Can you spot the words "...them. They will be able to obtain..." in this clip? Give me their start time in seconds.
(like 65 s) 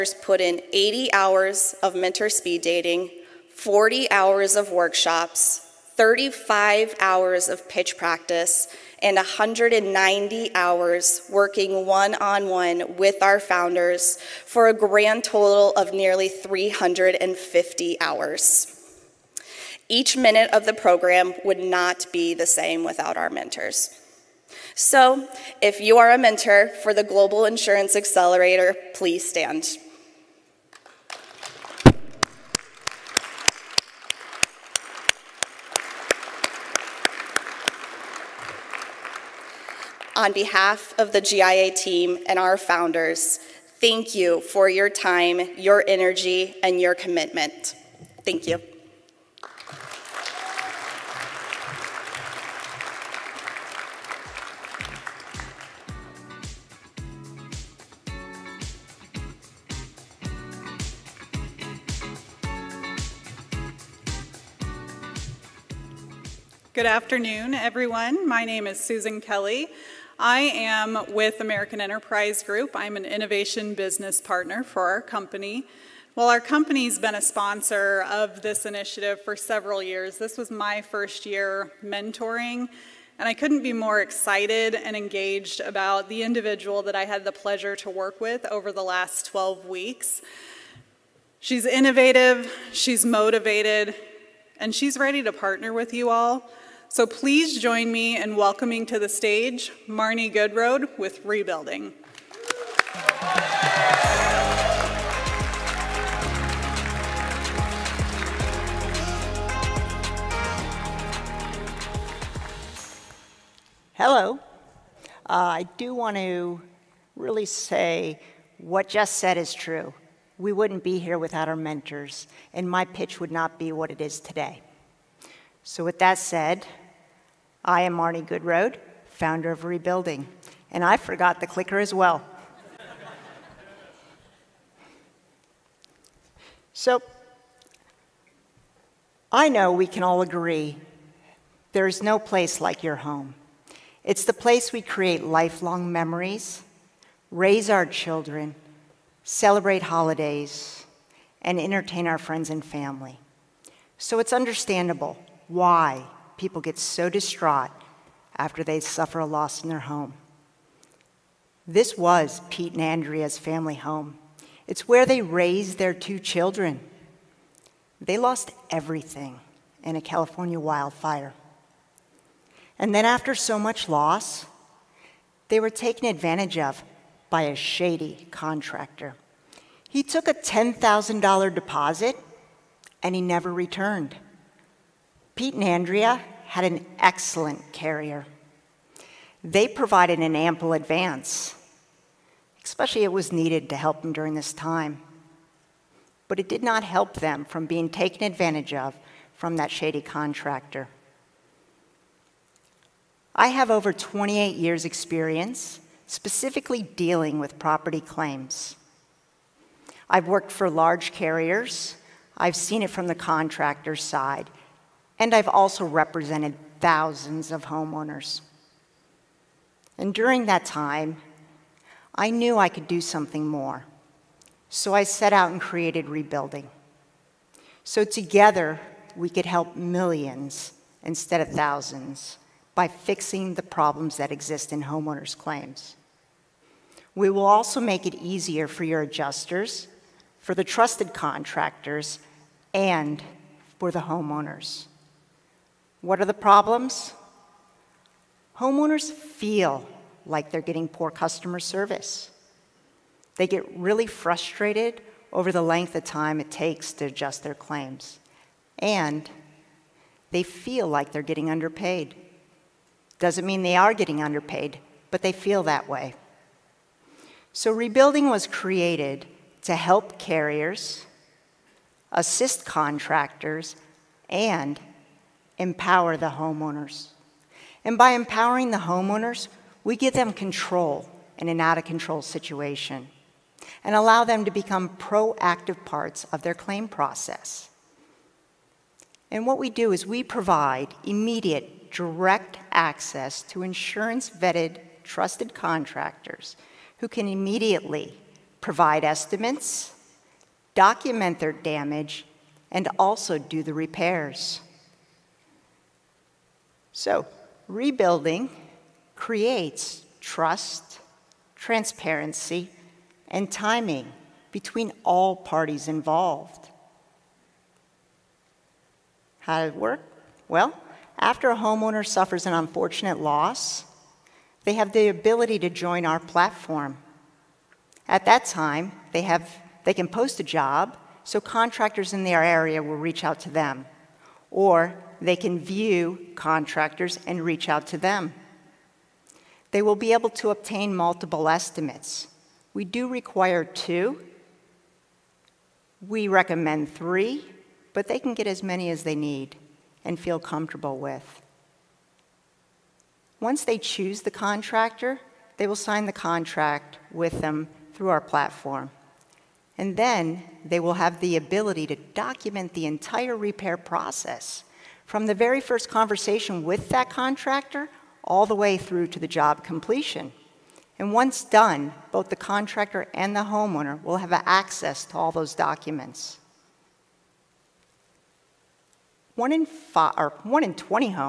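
337 s.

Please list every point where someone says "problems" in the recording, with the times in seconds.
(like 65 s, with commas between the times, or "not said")
233 s, 246 s.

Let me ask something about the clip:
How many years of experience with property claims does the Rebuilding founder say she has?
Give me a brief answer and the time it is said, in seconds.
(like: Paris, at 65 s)
28, at 203 s.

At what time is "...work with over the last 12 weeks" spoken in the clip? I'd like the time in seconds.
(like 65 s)
87 s.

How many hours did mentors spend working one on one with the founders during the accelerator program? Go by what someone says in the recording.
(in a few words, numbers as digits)
190.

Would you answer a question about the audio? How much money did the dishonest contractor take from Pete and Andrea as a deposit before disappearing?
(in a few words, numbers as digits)
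$10,000.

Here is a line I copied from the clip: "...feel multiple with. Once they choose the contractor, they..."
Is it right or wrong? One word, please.
wrong.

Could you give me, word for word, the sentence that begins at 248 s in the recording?
Homeowners feel like they're getting poor customer service.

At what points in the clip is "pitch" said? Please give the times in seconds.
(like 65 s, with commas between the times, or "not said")
7 s, 122 s.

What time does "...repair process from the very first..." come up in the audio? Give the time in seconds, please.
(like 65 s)
363 s.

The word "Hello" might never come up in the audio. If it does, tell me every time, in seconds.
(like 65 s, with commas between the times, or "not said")
113 s.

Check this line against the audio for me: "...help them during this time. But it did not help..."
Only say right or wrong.
right.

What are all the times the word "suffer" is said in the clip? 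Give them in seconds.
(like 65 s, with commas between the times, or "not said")
158 s, 322 s.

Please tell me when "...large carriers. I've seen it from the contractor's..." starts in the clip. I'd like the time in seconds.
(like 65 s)
210 s.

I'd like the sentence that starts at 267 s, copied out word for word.
So, rebuilding was created to help carriers, assist contractors, and empower the homeowners.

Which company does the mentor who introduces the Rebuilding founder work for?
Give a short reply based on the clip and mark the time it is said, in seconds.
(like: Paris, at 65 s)
American Enterprise Group, at 71 s.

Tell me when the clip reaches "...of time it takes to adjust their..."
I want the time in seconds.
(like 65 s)
255 s.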